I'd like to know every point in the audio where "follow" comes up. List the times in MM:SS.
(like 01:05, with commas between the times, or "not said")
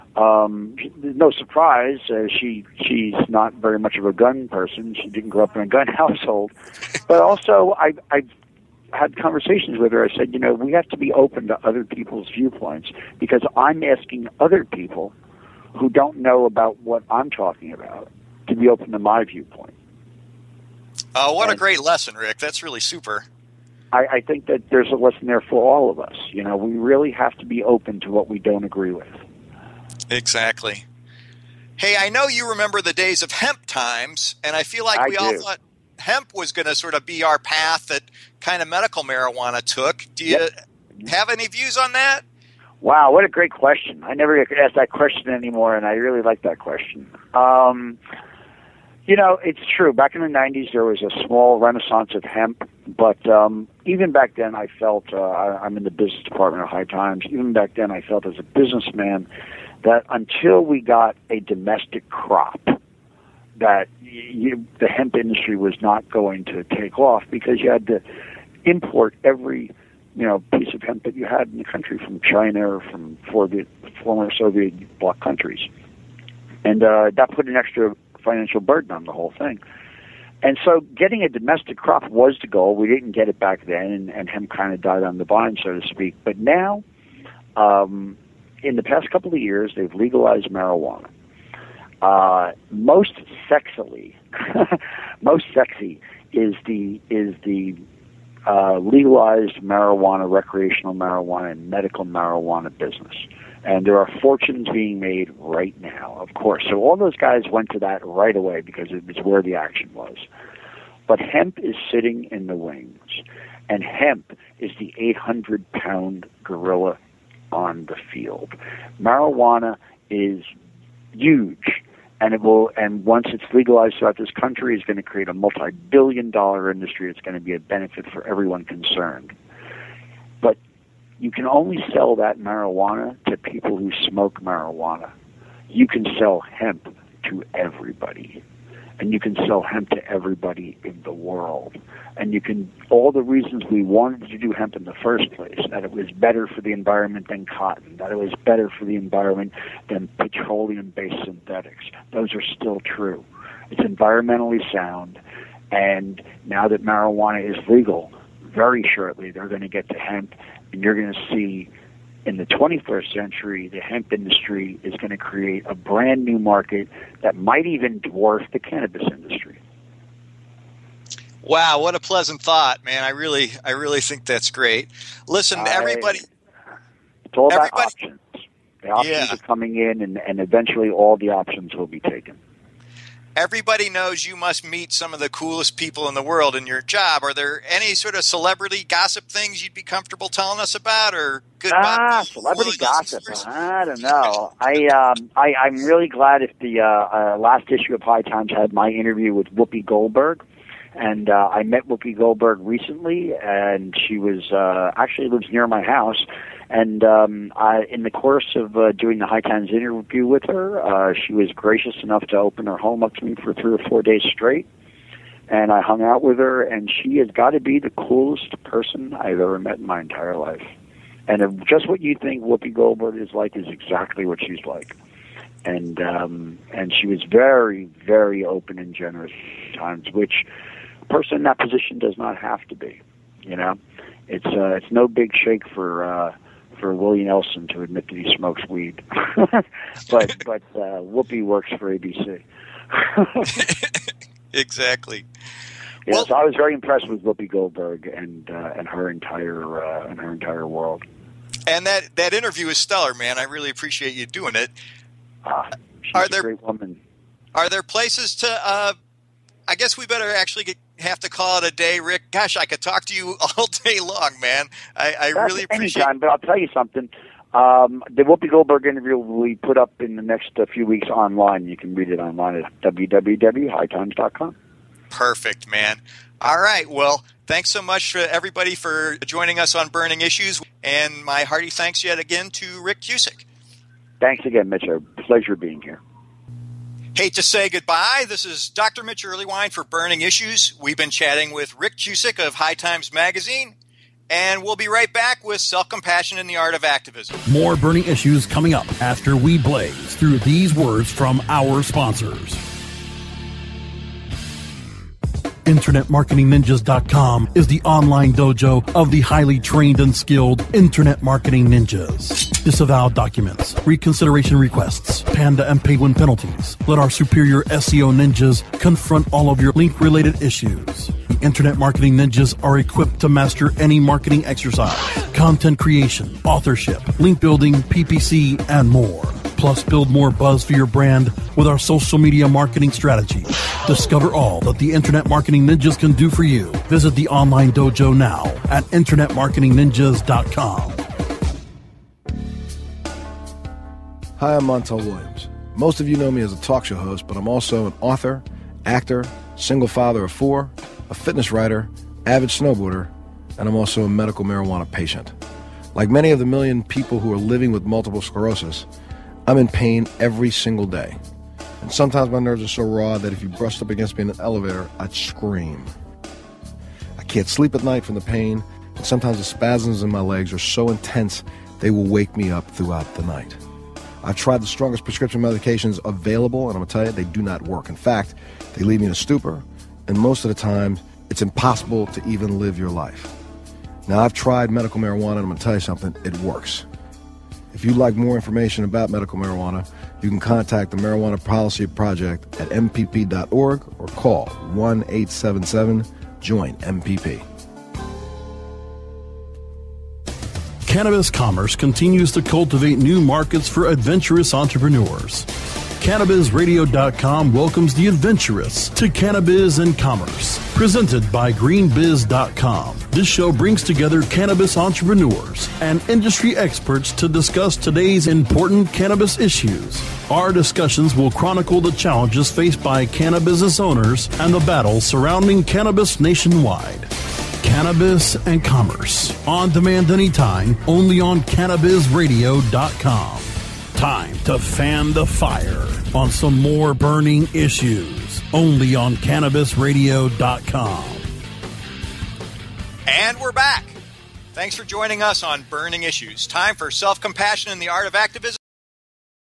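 not said.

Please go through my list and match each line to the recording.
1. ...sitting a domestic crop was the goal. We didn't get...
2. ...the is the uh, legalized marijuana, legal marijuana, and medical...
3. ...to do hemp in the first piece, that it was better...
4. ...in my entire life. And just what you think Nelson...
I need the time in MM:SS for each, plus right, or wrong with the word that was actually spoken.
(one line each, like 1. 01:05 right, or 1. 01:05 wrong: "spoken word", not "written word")
1. 01:20 wrong: "getting", not "sitting"
2. 01:36 wrong: "recreational", not "legal"
3. 02:24 wrong: "place", not "piece"
4. 03:39 wrong: "Whoopi", not "Nelson".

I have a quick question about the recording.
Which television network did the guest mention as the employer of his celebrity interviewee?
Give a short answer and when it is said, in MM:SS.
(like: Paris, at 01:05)
ABC, at 04:01.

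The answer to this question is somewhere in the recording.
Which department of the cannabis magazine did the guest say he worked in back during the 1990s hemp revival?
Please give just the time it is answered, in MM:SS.
00:55.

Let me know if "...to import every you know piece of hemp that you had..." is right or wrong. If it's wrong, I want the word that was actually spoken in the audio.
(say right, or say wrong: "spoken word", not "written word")
right.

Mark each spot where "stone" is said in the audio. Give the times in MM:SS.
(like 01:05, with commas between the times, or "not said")
not said.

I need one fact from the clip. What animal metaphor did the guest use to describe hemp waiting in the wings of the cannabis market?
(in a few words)
800 pound gorilla.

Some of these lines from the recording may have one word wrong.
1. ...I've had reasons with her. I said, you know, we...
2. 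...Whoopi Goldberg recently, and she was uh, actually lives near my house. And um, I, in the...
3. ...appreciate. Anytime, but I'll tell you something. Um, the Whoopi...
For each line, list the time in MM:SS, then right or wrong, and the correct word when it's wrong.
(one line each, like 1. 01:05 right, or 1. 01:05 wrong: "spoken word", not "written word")
1. 00:08 wrong: "conversations", not "reasons"
2. 03:21 right
3. 04:25 right.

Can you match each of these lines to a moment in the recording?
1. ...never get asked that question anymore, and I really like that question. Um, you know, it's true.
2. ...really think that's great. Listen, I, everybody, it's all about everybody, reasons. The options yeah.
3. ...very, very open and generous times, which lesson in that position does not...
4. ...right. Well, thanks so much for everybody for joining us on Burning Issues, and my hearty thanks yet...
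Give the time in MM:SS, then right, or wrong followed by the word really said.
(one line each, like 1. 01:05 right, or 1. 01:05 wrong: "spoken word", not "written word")
1. 00:44 right
2. 02:53 wrong: "options", not "reasons"
3. 03:47 wrong: "person", not "lesson"
4. 04:36 right.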